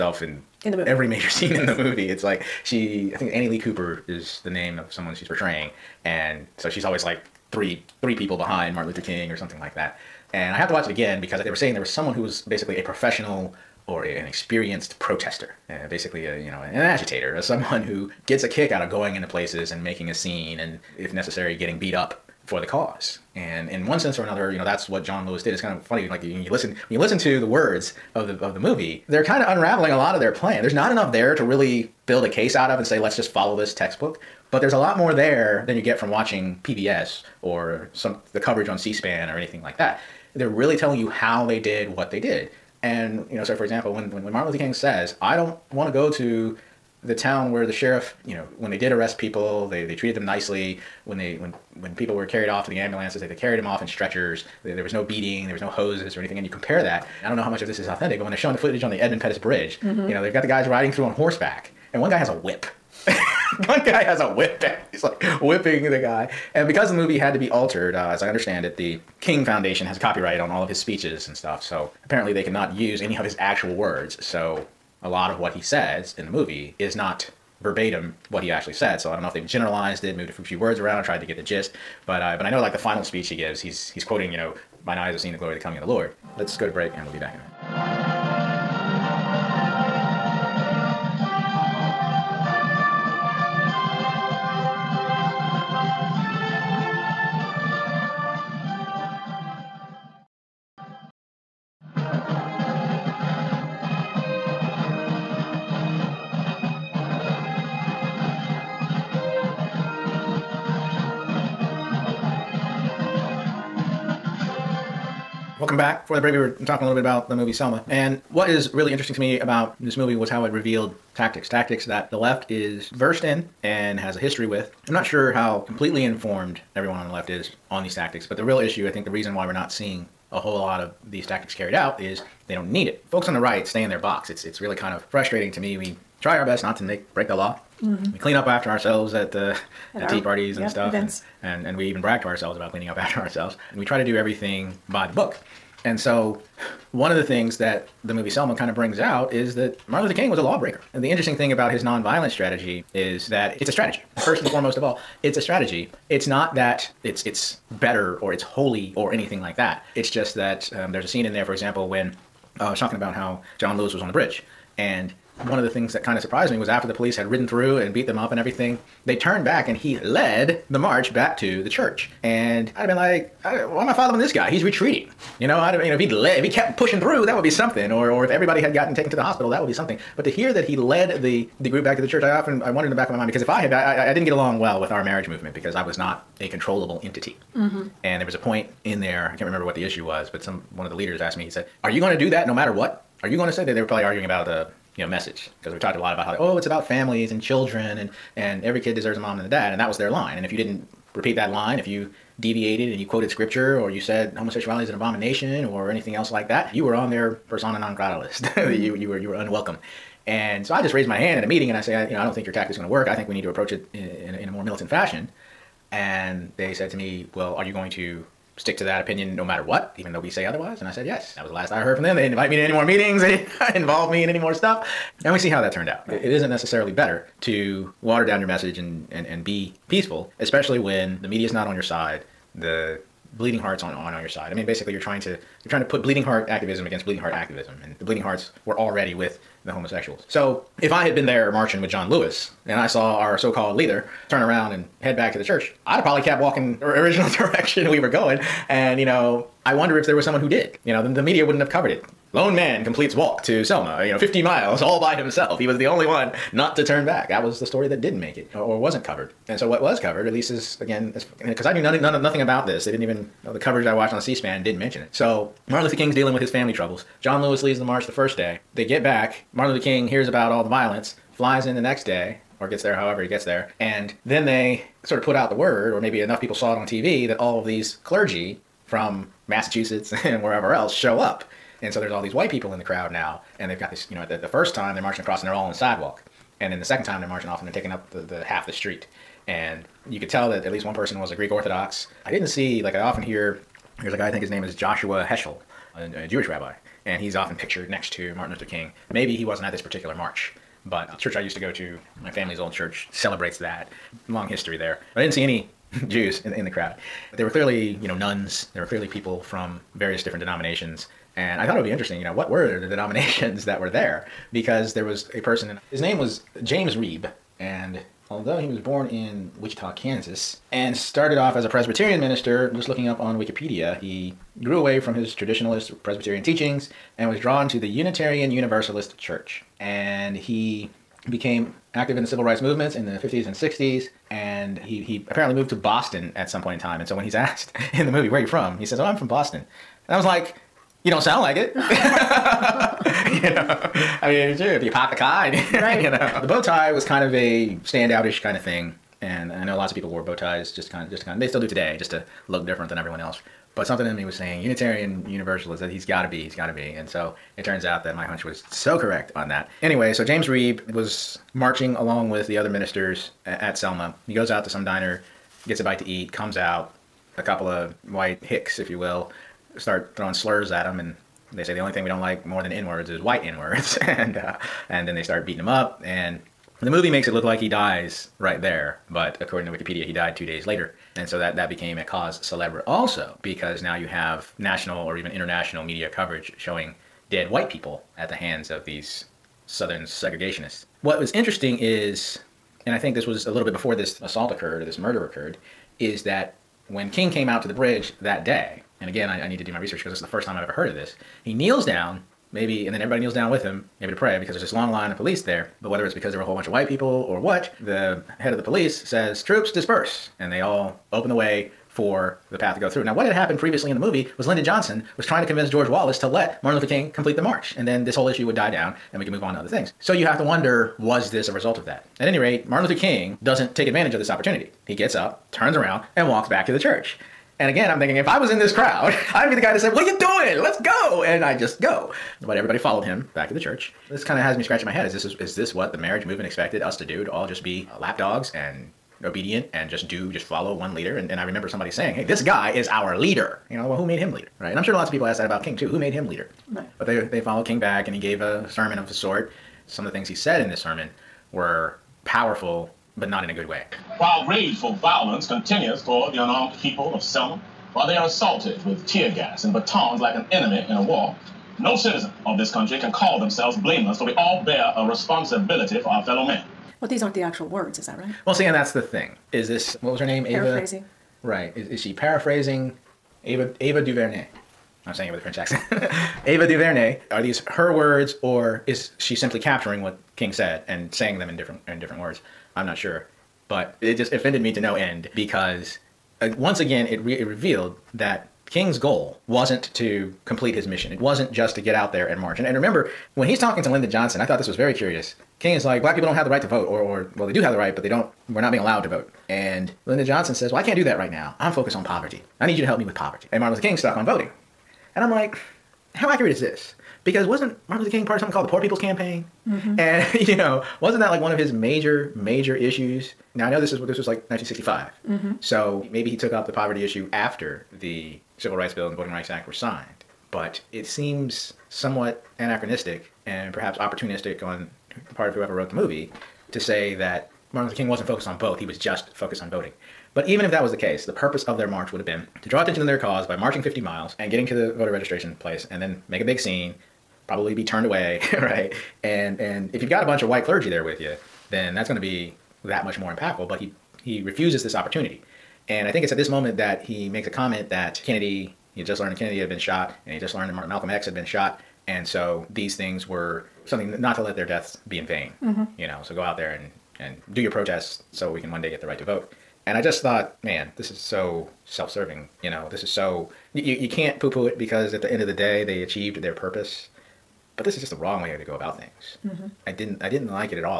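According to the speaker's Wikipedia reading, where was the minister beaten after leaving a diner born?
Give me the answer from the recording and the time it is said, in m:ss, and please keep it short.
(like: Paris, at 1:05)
Wichita, Kansas, at 5:19.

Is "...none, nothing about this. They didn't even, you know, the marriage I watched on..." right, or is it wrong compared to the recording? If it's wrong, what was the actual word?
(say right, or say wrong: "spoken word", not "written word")
wrong: "coverage", not "marriage".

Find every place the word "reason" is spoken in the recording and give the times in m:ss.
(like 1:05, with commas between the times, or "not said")
2:09.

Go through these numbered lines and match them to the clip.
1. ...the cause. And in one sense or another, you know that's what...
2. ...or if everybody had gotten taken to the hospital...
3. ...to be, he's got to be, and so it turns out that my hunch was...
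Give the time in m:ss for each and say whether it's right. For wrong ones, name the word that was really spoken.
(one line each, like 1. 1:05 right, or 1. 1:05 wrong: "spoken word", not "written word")
1. 0:22 right
2. 2:58 right
3. 5:56 right.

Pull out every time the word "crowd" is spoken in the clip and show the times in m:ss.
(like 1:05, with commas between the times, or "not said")
4:42, 5:06, 7:08.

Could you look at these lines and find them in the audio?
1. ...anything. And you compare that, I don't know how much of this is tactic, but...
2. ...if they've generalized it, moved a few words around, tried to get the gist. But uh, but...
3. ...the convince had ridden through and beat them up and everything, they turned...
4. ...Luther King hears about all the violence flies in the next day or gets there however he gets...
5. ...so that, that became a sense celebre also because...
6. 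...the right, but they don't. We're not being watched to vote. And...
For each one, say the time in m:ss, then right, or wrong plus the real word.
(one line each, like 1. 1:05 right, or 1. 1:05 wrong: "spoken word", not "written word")
1. 0:56 wrong: "authentic", not "tactic"
2. 1:19 right
3. 2:46 wrong: "police", not "convince"
4. 4:29 right
5. 6:21 wrong: "cause", not "sense"
6. 8:17 wrong: "allowed", not "watched".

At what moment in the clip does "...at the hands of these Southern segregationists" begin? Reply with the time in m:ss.
6:28.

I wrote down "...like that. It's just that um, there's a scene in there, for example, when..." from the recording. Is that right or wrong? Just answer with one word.
right.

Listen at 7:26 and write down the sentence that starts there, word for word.
But they they followed King back, and he gave a sermon of a sort.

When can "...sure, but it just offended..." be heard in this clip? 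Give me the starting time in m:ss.
8:02.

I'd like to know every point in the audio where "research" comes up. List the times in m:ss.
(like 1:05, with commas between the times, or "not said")
6:39.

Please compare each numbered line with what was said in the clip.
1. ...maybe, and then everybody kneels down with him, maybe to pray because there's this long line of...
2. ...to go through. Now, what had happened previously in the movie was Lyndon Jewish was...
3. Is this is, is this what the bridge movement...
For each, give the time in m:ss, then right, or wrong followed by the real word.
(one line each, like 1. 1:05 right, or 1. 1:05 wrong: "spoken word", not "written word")
1. 6:42 right
2. 6:52 wrong: "Johnson", not "Jewish"
3. 7:15 wrong: "marriage", not "bridge".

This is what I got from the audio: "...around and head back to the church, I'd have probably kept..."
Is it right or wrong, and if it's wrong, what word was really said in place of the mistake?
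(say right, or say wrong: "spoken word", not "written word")
right.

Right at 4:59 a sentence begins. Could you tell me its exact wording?
Maybe he wasn't at this particular march, but the church I used to go to, my family's old church, celebrates that.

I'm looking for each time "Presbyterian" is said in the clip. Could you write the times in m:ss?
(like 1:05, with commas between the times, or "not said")
5:21, 5:26.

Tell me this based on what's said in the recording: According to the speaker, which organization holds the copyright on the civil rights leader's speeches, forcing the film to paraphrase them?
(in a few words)
the King Foundation.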